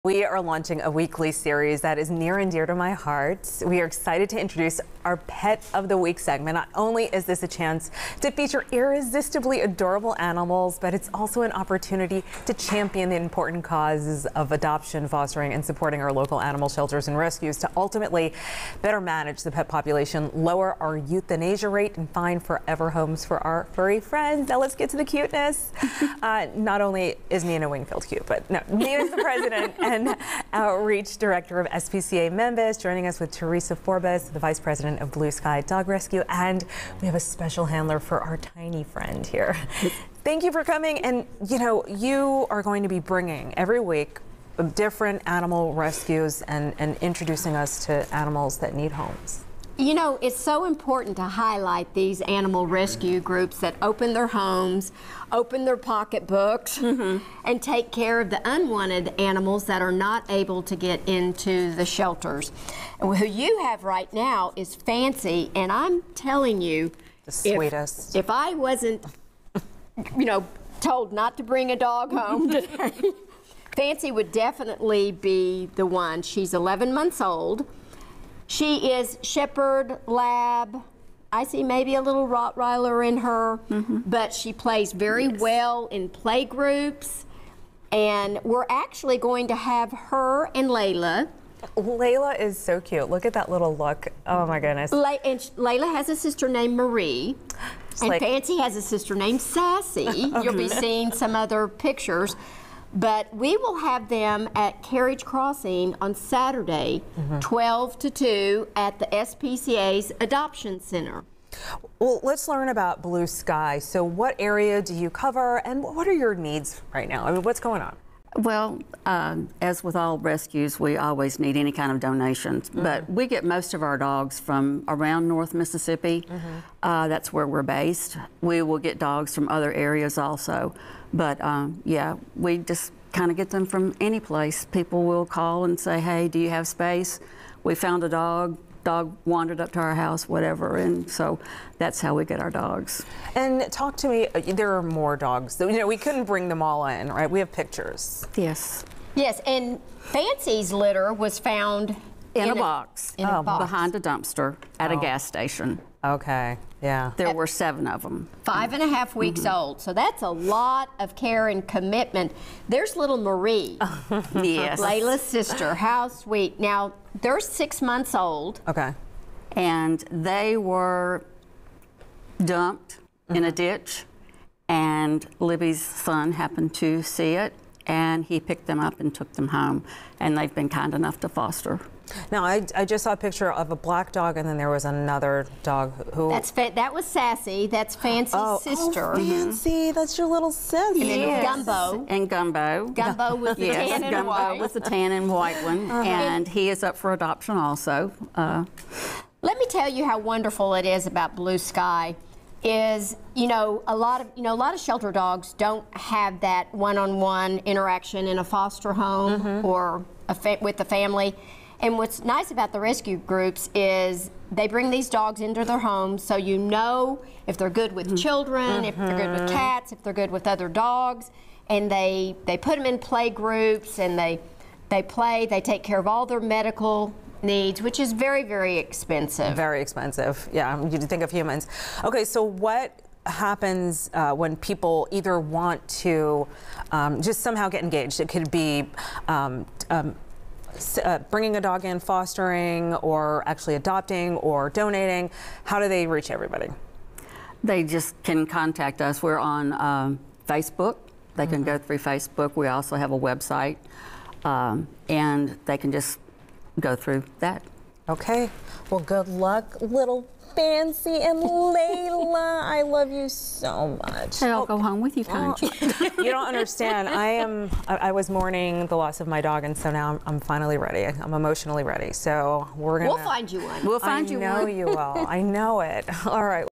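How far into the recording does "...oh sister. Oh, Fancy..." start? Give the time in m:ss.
3:08.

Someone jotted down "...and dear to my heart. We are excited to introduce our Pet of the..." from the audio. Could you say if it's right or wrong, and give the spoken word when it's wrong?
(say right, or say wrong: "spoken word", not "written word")
right.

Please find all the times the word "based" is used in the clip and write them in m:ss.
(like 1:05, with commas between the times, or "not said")
2:07.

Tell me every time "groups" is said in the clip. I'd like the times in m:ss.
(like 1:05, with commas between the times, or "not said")
0:53, 1:26, 3:33, 3:43.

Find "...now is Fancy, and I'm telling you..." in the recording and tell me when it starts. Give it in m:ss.
1:04.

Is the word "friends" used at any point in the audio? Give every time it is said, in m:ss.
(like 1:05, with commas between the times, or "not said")
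0:23, 0:38.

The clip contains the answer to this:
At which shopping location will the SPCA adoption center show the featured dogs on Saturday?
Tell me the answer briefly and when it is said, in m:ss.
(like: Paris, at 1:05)
Carriage Crossing, at 1:44.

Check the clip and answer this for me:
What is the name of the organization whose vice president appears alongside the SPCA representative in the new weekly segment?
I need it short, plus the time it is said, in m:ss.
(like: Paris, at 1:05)
Blue Sky Dog Rescue, at 0:35.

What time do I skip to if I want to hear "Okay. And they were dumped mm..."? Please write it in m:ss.
2:48.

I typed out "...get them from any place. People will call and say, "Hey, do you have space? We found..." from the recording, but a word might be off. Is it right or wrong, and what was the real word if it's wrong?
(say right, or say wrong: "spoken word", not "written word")
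right.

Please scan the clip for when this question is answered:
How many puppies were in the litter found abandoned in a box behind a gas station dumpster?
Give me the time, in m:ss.
2:37.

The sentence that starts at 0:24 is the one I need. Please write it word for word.
Now let's get to the cuteness.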